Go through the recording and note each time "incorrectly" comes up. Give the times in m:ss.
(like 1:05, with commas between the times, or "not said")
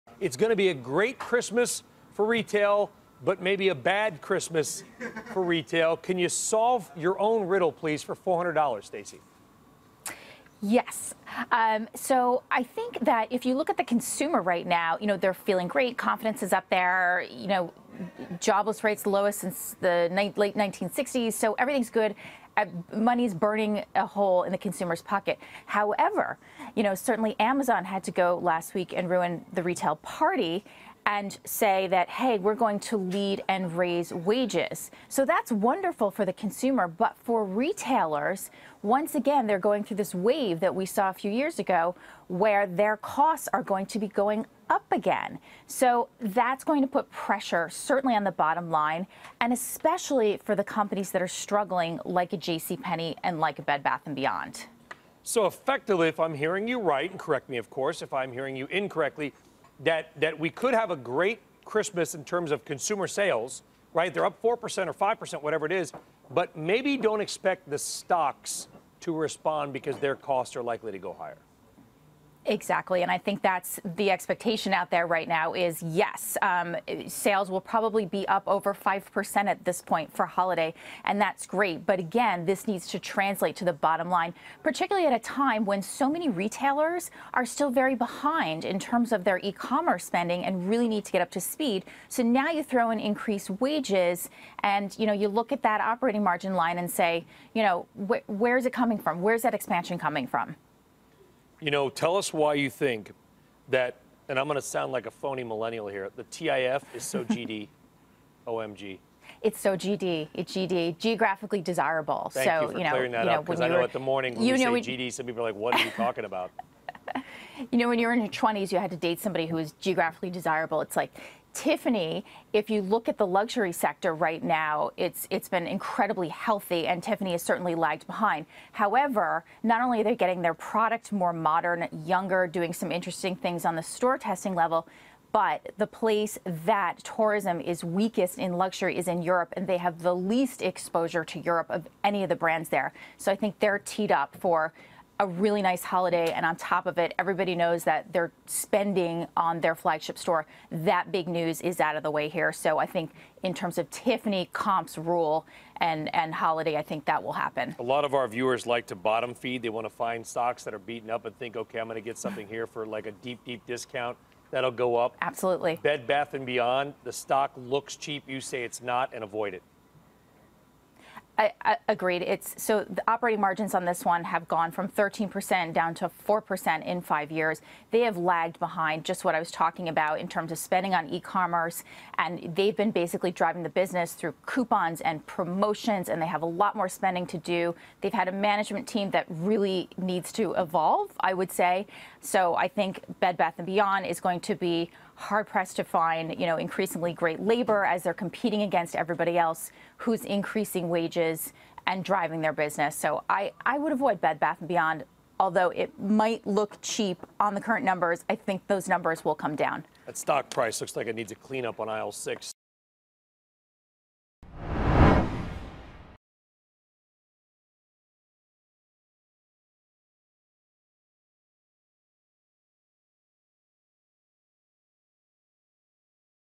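0:58.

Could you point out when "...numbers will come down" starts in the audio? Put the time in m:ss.
3:28.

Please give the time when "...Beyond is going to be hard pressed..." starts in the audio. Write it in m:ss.
3:13.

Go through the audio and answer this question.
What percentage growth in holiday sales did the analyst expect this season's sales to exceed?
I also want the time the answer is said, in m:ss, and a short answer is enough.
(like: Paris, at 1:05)
5%, at 1:18.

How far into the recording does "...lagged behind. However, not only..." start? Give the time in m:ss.
2:07.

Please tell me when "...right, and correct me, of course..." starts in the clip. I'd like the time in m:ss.
0:56.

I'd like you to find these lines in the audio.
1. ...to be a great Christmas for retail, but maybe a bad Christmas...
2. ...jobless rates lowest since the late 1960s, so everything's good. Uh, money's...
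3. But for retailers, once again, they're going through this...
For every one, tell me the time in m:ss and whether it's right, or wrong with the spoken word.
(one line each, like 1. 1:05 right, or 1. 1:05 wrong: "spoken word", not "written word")
1. 0:00 right
2. 0:18 right
3. 0:36 right.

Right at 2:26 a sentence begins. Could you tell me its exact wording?
And on top of it, everybody knows that they're spending on their flagship store.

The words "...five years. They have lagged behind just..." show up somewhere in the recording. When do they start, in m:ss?
2:57.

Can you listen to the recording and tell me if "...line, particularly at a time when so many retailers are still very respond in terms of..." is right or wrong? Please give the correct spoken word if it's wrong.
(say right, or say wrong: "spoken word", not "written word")
wrong: "behind", not "respond".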